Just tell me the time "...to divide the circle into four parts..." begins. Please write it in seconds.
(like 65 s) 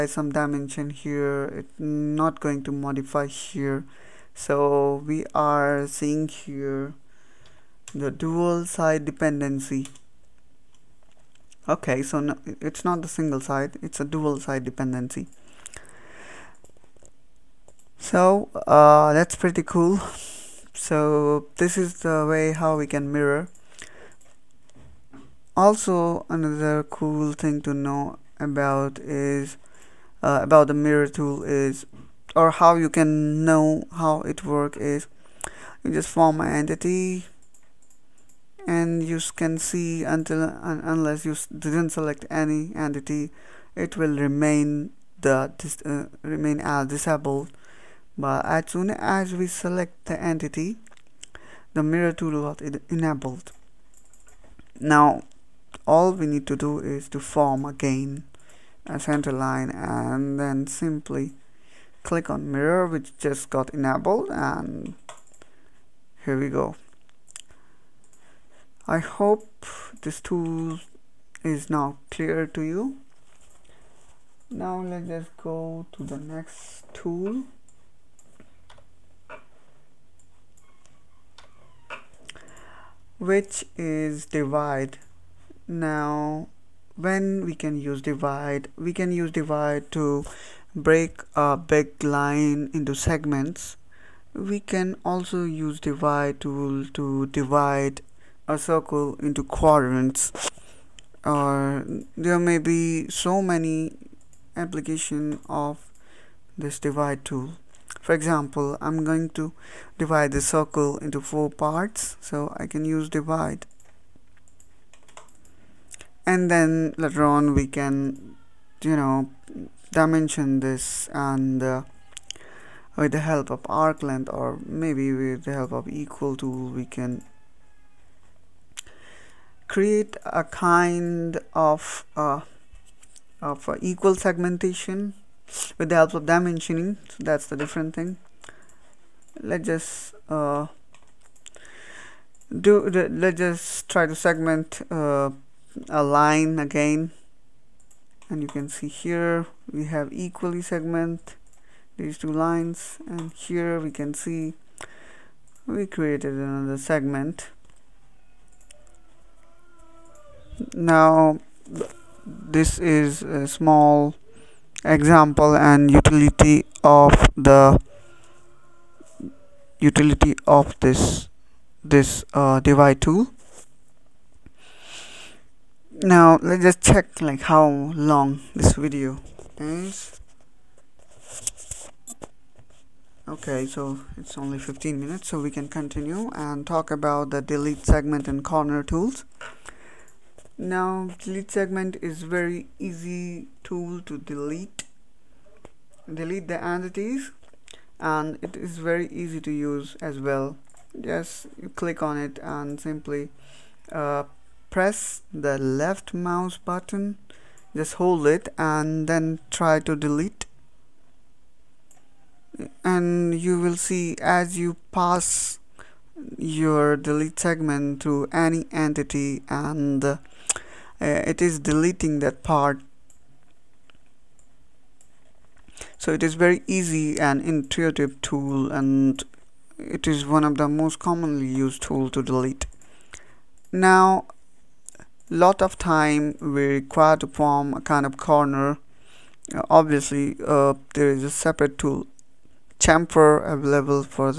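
109 s.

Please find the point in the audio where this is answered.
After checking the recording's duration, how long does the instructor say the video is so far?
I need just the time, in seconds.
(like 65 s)
184 s.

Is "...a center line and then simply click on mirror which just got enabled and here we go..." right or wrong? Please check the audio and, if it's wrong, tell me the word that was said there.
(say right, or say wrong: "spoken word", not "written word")
right.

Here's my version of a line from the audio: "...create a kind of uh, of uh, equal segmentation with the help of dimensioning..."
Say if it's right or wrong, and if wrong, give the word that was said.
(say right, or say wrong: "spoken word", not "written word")
right.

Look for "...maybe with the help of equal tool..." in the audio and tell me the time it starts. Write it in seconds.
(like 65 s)
124 s.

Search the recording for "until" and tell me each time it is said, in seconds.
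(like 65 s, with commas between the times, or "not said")
40 s.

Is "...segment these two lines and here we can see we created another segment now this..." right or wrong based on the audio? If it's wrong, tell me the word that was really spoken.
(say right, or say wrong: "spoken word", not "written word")
right.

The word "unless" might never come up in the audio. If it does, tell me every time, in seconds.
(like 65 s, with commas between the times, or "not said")
40 s.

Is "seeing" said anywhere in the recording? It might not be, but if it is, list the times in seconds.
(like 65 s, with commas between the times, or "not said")
5 s.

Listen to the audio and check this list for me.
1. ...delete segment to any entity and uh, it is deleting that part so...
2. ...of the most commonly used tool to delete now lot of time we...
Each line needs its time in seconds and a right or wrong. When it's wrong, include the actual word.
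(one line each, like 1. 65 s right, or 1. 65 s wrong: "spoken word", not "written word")
1. 216 s right
2. 230 s right.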